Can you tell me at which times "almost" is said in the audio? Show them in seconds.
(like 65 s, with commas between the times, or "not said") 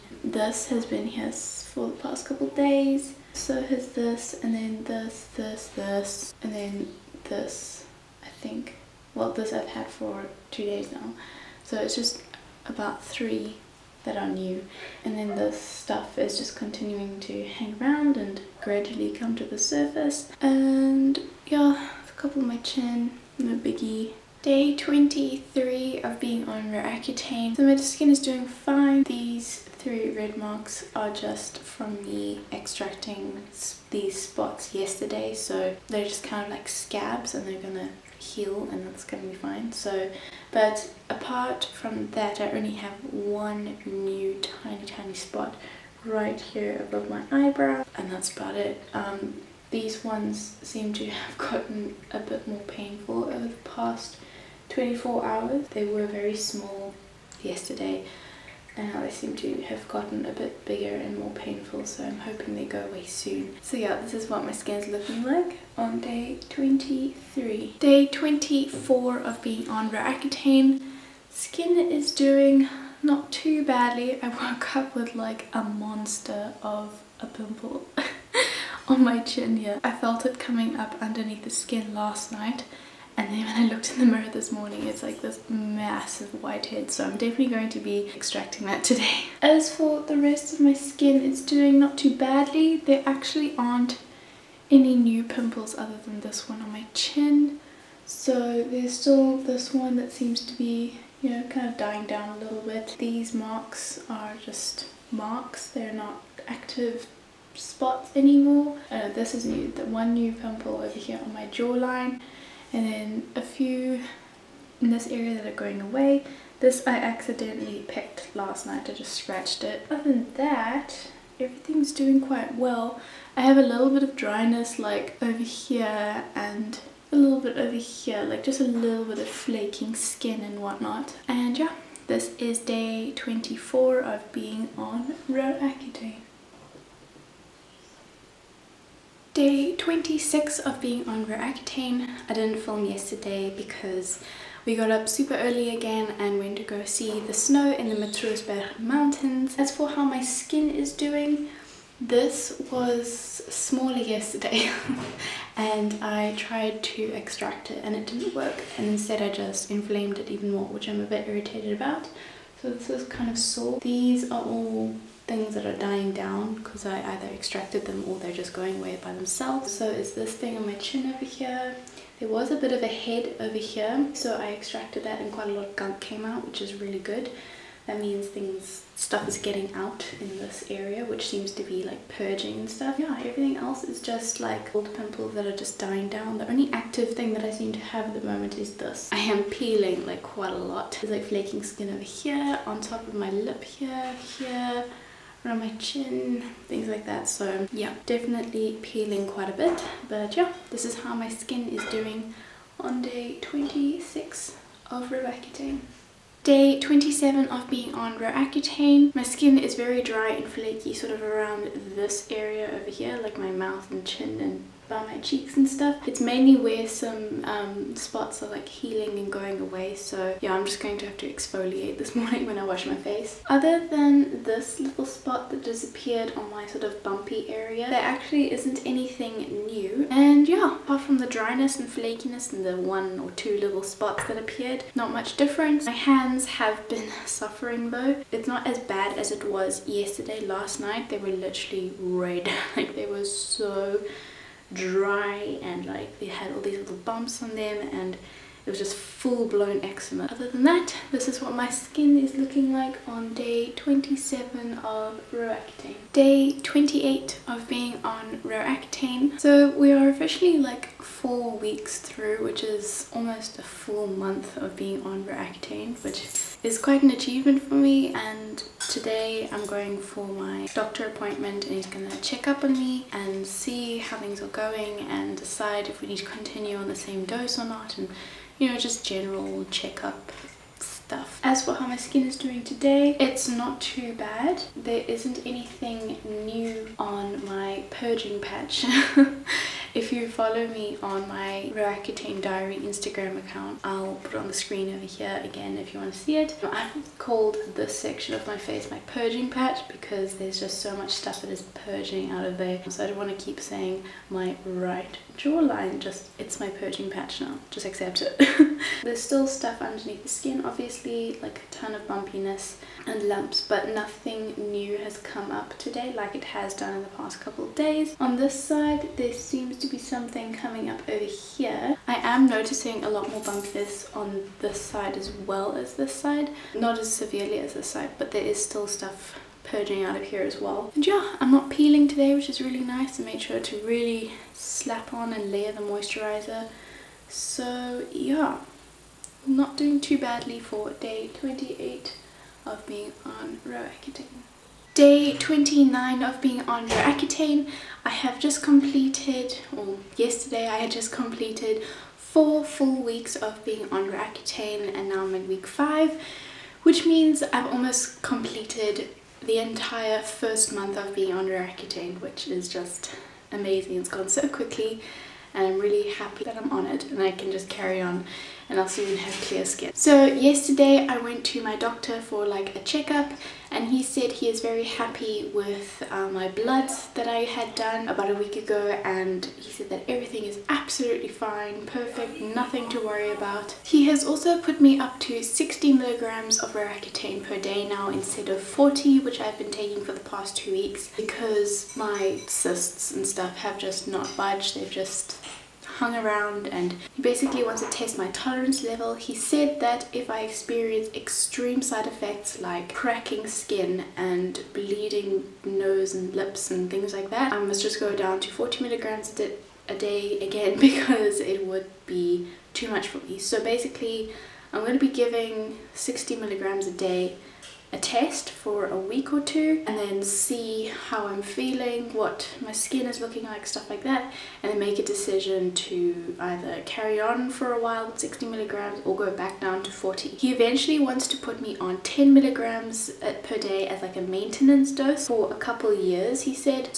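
263 s, 357 s.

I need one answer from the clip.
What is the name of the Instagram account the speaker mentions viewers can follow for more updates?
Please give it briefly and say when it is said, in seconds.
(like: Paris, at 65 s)
Roaccutane Diary, at 291 s.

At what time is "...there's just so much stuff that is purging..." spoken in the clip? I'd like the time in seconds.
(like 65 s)
300 s.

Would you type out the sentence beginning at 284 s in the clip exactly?
There isn't anything new on my purging patch.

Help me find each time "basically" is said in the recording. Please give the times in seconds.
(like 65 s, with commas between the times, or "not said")
397 s, 413 s.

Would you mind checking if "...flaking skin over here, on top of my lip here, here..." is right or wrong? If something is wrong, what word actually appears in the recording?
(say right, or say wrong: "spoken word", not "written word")
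right.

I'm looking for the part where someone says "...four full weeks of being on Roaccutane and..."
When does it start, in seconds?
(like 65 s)
352 s.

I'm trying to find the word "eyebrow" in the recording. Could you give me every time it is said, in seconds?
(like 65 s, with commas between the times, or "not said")
47 s.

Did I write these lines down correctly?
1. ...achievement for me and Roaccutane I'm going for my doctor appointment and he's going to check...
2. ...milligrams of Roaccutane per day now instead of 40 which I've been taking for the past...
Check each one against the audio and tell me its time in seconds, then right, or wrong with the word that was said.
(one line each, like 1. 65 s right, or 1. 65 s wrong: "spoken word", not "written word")
1. 267 s wrong: "Today", not "Roaccutane"
2. 385 s right.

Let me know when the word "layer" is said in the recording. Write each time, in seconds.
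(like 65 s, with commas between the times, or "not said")
335 s.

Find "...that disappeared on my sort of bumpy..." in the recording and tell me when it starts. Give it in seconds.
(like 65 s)
225 s.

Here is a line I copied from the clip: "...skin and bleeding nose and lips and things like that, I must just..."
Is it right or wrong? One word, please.
right.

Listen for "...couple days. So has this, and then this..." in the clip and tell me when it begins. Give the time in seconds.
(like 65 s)
2 s.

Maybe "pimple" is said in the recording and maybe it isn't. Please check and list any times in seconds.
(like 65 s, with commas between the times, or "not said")
77 s, 95 s, 110 s, 184 s.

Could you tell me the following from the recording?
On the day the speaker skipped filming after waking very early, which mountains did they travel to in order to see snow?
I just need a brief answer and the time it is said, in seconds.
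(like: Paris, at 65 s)
Matroosberg mountains, at 147 s.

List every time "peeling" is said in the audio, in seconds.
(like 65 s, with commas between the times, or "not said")
189 s, 198 s, 331 s.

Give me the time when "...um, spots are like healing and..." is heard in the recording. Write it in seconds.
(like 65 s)
217 s.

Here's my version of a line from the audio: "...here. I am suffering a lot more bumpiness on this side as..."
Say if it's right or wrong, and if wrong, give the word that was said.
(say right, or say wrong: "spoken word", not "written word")
wrong: "noticing", not "suffering".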